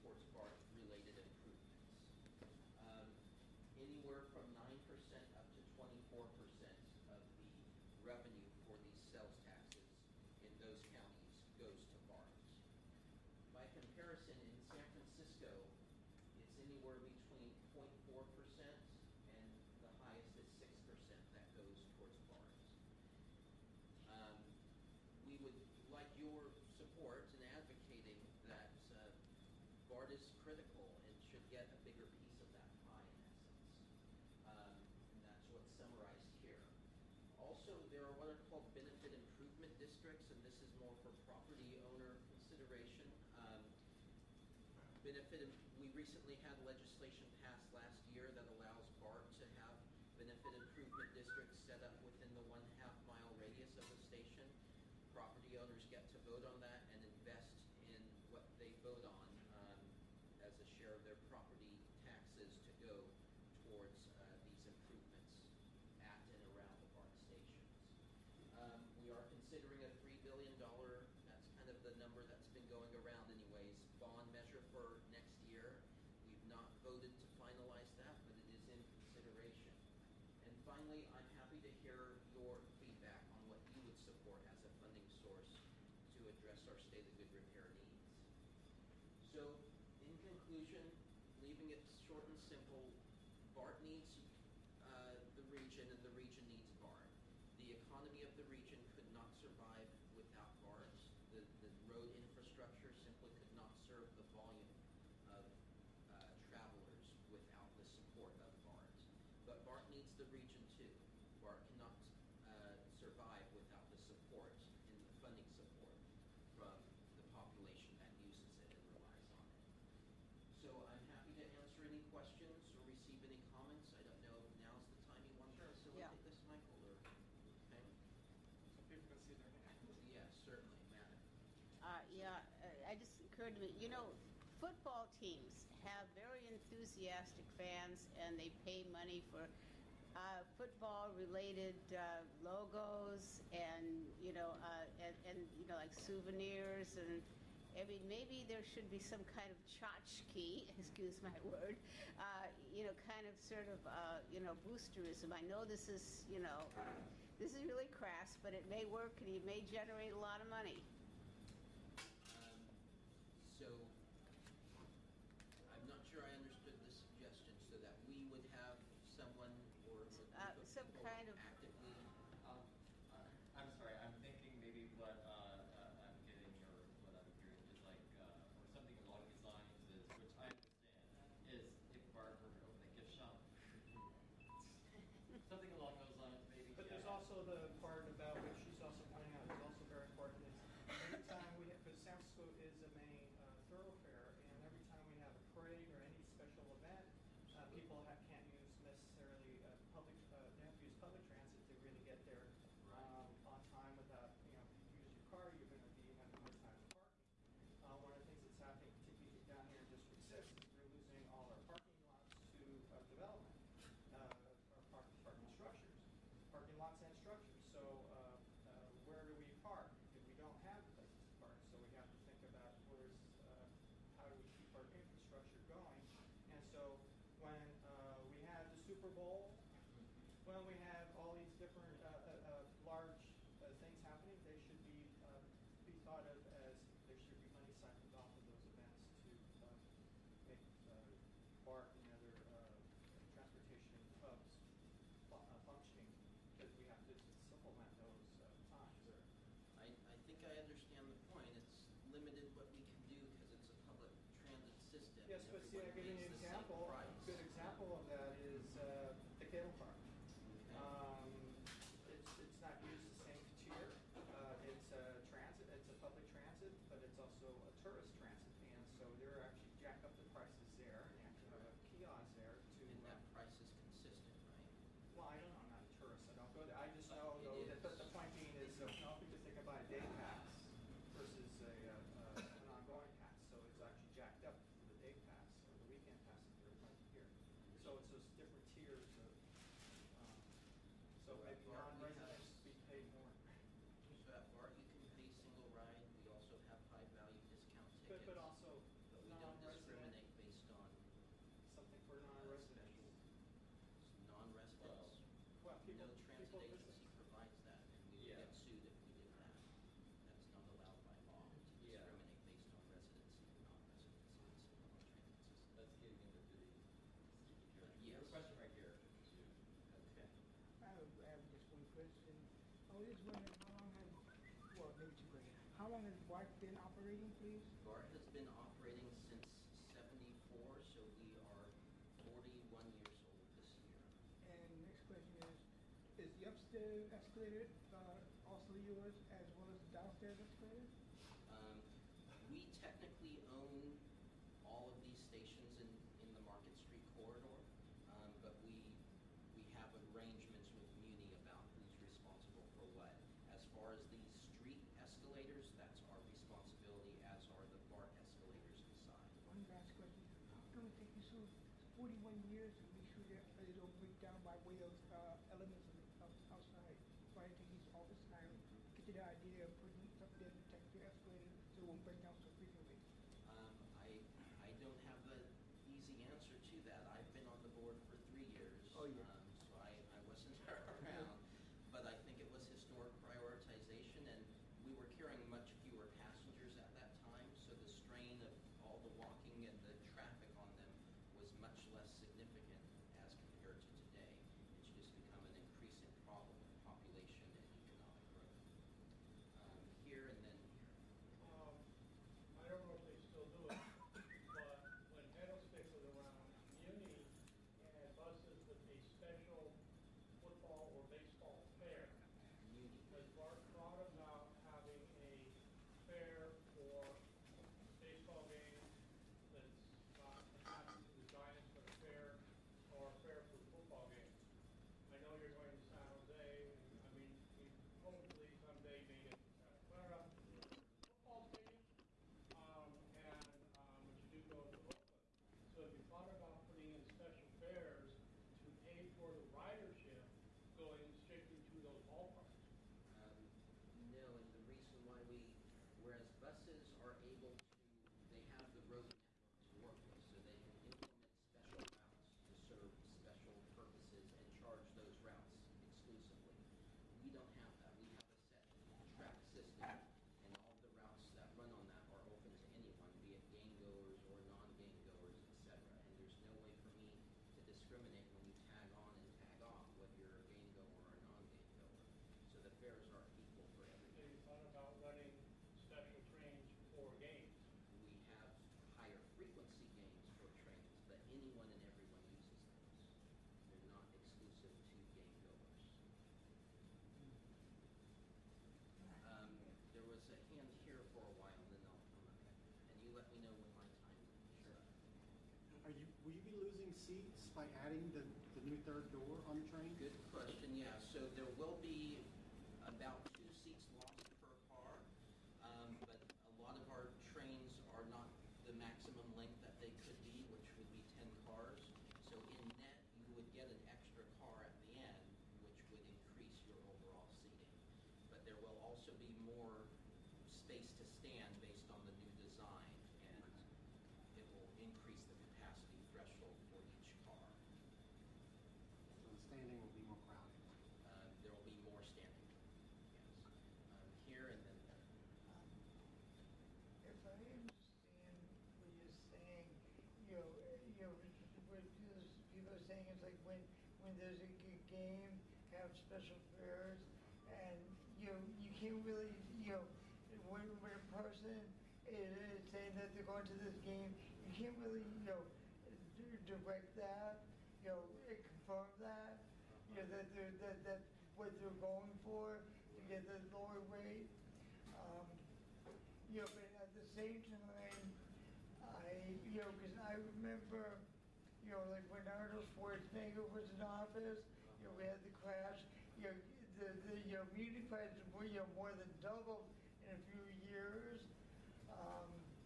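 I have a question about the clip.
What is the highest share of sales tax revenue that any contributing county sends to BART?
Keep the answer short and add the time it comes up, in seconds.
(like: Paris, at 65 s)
24%, at 5 s.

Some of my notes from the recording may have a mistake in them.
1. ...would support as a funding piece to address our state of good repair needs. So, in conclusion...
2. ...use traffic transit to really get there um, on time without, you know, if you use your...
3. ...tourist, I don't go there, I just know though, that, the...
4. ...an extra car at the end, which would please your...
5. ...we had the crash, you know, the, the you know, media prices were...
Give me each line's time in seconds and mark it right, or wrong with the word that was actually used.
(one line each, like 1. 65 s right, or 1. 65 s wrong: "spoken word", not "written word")
1. 83 s wrong: "source", not "piece"
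2. 200 s wrong: "public", not "traffic"
3. 275 s right
4. 513 s wrong: "increase", not "please"
5. 574 s right.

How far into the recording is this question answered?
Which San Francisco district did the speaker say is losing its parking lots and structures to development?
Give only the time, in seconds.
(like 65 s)
209 s.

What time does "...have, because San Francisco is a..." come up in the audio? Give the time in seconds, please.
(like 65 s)
191 s.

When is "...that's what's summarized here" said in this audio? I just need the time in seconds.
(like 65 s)
35 s.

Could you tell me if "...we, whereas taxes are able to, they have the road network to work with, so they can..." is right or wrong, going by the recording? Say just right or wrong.
wrong.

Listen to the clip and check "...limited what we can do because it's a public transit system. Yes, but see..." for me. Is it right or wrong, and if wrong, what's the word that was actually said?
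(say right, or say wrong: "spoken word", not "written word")
right.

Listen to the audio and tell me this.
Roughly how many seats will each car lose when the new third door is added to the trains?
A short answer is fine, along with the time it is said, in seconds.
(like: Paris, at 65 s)
2, at 503 s.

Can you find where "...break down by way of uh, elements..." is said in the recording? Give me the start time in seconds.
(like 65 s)
363 s.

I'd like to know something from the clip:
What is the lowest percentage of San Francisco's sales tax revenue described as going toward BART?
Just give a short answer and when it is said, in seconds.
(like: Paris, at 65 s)
0.4%, at 17 s.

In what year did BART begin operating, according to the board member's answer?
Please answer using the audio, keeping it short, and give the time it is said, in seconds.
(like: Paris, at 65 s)
1974, at 329 s.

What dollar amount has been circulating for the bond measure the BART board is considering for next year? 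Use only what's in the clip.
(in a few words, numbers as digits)
$3 billion.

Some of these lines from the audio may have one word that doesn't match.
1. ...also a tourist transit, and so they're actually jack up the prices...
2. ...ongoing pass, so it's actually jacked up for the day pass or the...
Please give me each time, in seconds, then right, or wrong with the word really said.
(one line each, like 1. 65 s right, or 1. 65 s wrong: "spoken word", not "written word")
1. 267 s right
2. 282 s right.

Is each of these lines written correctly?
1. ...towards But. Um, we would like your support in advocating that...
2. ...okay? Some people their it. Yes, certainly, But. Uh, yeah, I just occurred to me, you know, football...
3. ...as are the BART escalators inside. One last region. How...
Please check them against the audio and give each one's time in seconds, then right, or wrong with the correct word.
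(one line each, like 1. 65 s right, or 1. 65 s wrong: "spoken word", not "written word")
1. 21 s wrong: "BART", not "But"
2. 126 s wrong: "Matt", not "But"
3. 357 s wrong: "question", not "region".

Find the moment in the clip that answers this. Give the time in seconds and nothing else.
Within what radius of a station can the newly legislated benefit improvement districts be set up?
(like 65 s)
52 s.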